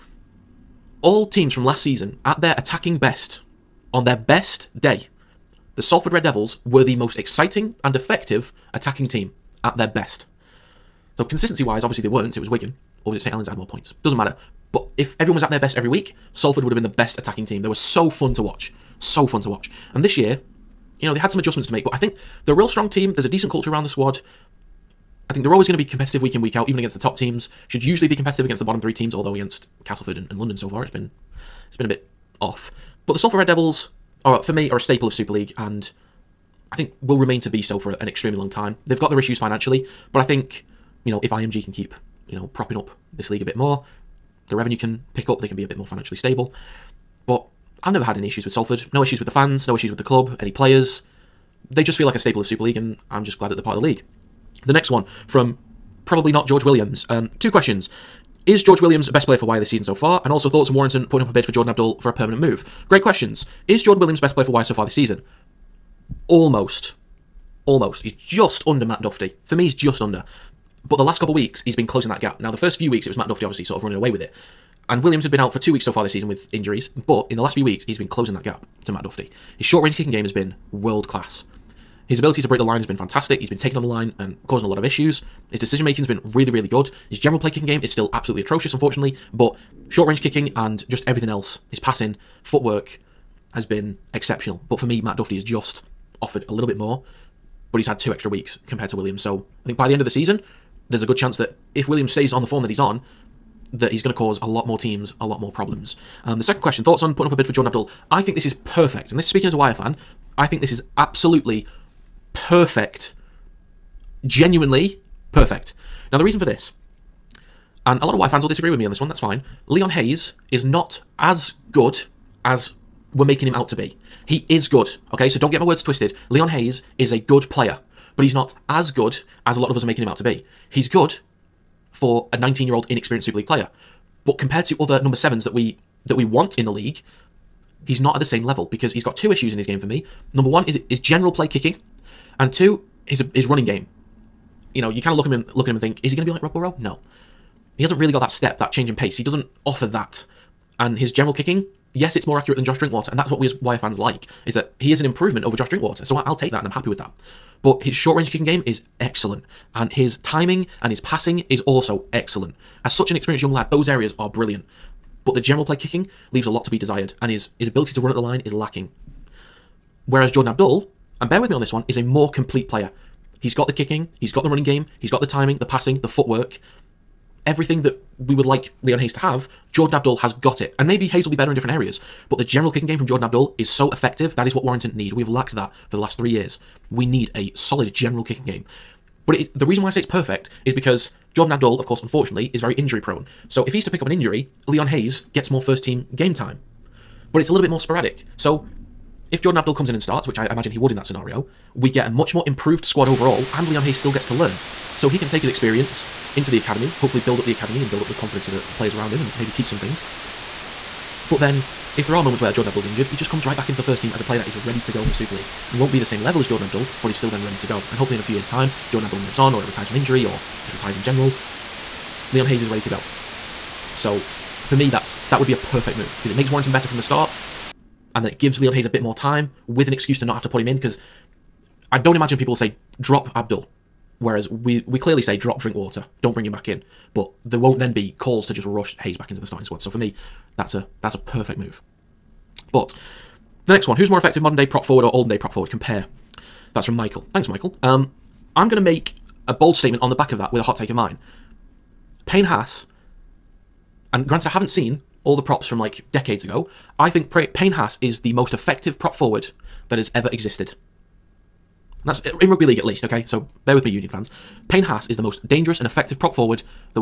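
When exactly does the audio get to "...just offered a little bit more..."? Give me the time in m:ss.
1:35.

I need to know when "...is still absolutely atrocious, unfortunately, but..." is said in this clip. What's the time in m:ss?
1:27.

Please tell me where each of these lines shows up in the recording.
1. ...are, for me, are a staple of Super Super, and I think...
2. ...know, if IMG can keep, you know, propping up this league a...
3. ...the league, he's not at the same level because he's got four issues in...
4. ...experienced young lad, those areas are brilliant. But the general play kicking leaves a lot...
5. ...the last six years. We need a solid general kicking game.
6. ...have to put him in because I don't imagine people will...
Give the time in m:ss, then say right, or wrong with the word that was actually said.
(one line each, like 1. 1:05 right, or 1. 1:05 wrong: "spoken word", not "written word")
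1. 0:34 wrong: "League", not "Super"
2. 0:41 right
3. 2:16 wrong: "two", not "four"
4. 2:43 right
5. 3:05 wrong: "three", not "six"
6. 3:50 right.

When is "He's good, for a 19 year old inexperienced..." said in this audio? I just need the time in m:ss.
2:10.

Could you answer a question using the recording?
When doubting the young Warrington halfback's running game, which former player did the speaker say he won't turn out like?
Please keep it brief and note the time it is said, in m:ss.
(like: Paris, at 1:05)
Rob Burrow, at 2:26.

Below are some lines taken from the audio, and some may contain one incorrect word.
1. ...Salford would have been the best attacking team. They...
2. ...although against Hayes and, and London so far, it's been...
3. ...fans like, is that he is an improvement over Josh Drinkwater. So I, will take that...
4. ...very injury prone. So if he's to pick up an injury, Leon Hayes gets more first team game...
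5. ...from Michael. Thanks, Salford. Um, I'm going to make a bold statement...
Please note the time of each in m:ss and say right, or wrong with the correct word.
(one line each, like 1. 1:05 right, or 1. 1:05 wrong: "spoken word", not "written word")
1. 0:16 right
2. 0:29 wrong: "Castleford", not "Hayes"
3. 2:33 right
4. 3:12 right
5. 4:06 wrong: "Michael", not "Salford".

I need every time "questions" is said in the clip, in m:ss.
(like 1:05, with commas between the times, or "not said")
0:57, 1:03, 1:46.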